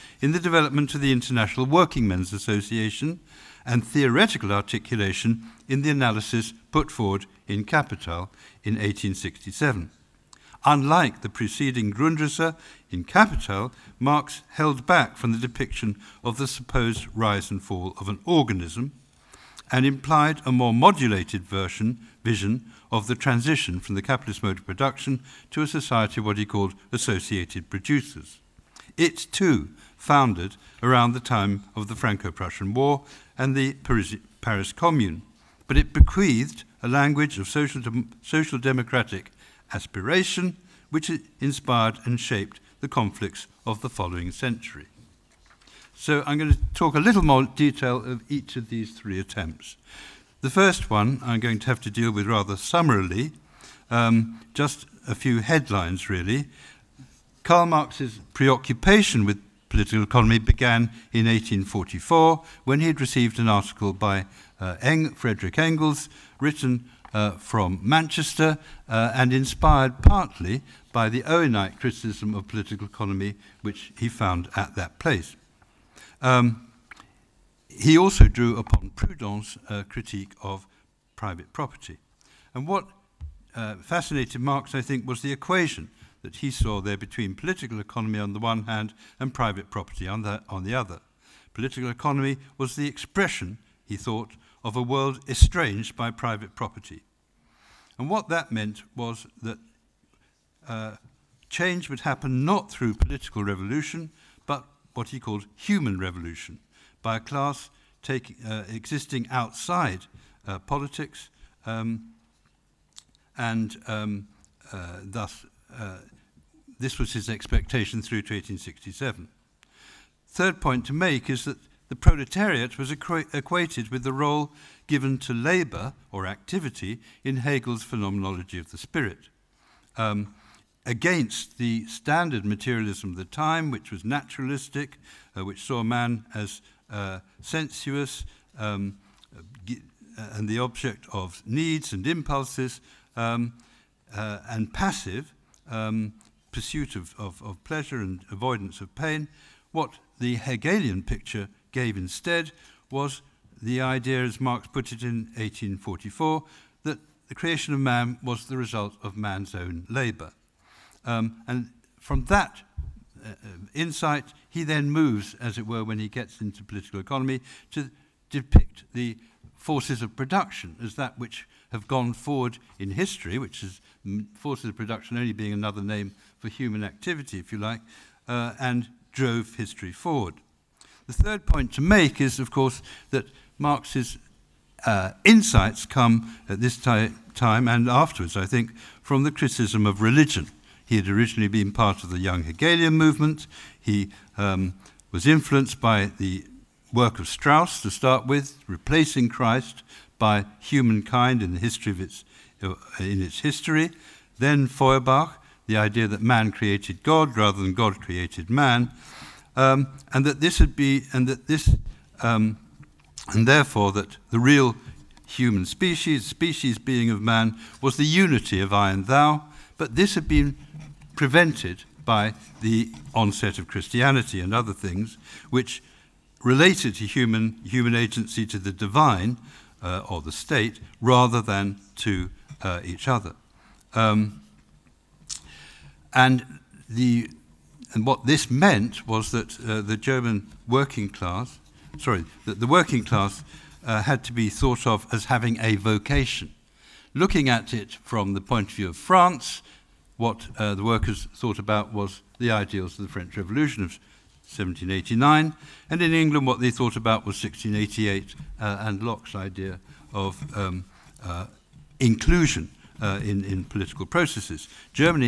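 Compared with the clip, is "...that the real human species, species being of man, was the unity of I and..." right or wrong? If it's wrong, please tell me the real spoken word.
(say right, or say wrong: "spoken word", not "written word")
right.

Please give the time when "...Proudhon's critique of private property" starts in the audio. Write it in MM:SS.
01:18.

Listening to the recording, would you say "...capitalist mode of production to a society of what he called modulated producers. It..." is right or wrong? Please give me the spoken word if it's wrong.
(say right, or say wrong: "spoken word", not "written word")
wrong: "associated", not "modulated".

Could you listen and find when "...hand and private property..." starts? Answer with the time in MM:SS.
01:28.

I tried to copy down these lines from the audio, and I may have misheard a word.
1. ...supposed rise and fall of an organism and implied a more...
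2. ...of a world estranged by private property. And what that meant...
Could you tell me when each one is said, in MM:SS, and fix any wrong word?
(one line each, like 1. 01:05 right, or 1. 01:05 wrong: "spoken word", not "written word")
1. 00:16 right
2. 01:34 right.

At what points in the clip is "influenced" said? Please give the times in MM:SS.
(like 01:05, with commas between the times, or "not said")
03:15.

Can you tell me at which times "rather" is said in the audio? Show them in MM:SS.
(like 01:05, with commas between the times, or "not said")
00:52, 03:27, 03:51.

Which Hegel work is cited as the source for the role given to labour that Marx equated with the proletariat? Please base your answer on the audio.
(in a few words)
Phenomenology of the Spirit.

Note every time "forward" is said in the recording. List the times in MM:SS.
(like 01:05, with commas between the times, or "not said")
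00:06, 02:52, 02:59.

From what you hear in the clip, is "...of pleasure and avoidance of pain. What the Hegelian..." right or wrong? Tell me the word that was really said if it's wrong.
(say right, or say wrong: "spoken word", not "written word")
right.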